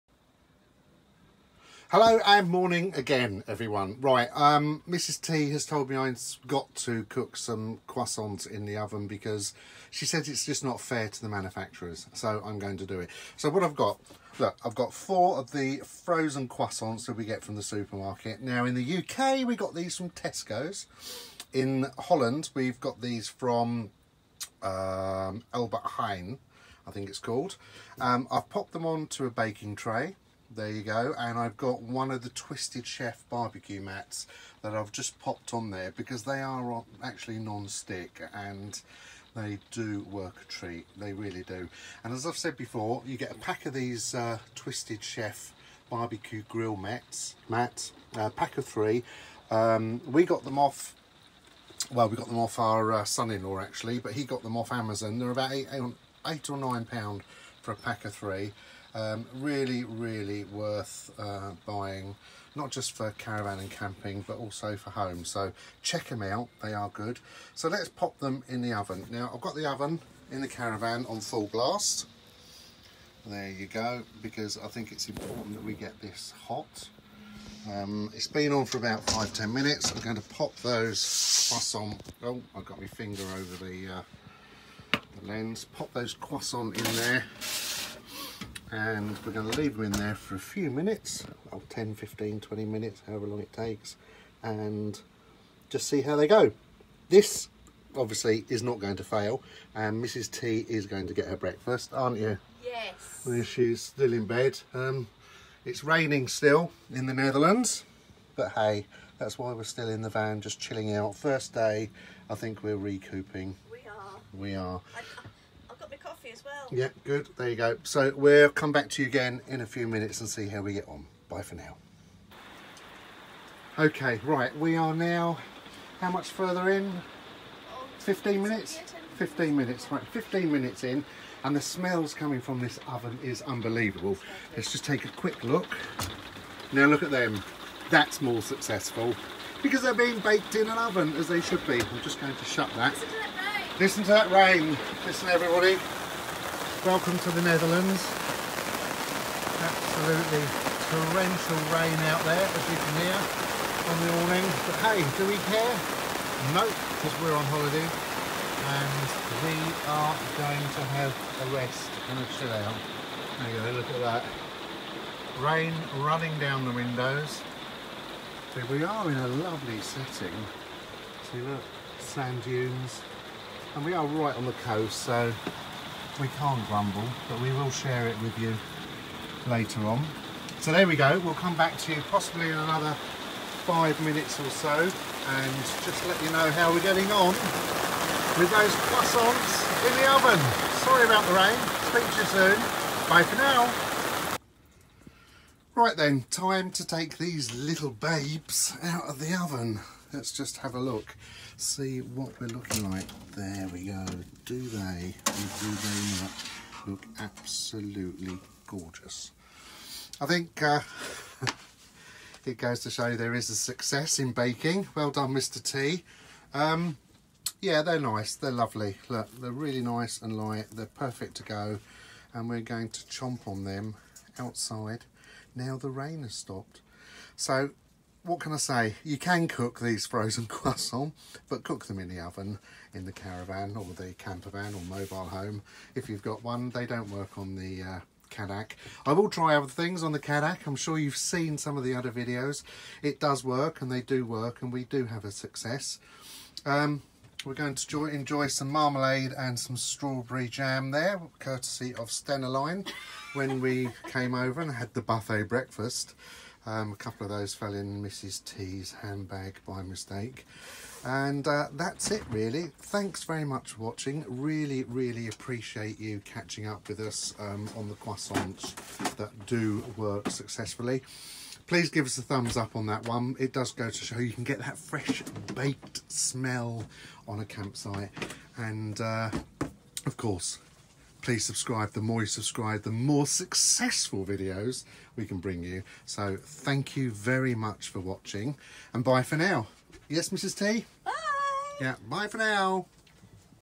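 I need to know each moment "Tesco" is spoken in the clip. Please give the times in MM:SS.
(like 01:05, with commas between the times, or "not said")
00:20.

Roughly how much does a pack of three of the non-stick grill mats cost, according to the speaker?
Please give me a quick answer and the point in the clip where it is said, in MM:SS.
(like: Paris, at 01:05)
8 or 9 pounds, at 00:56.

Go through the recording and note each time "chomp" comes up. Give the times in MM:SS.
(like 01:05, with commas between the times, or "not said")
03:43.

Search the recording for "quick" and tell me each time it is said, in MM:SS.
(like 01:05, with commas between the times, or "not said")
02:15.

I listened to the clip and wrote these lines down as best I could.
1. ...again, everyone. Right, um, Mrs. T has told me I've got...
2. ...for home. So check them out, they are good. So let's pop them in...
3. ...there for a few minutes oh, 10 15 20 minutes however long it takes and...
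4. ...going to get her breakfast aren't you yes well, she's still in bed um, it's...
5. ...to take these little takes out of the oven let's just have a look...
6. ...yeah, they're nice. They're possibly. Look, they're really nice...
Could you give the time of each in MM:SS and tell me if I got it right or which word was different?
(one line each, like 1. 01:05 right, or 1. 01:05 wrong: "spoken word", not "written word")
1. 00:02 right
2. 01:04 right
3. 01:29 right
4. 01:40 right
5. 03:16 wrong: "babes", not "takes"
6. 03:37 wrong: "lovely", not "possibly".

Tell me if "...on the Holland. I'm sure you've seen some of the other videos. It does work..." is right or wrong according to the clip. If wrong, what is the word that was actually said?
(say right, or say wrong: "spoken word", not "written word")
wrong: "Cadac", not "Holland".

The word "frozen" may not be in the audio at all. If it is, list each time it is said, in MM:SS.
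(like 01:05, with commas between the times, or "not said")
00:15, 03:50.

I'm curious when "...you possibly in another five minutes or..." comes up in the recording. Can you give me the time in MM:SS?
03:01.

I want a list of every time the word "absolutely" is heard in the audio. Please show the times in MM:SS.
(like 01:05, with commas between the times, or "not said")
02:29, 03:27.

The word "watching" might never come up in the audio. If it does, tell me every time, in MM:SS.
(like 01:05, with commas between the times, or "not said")
04:23, 04:47.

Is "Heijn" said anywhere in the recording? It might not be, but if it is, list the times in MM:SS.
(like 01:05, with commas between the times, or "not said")
00:25.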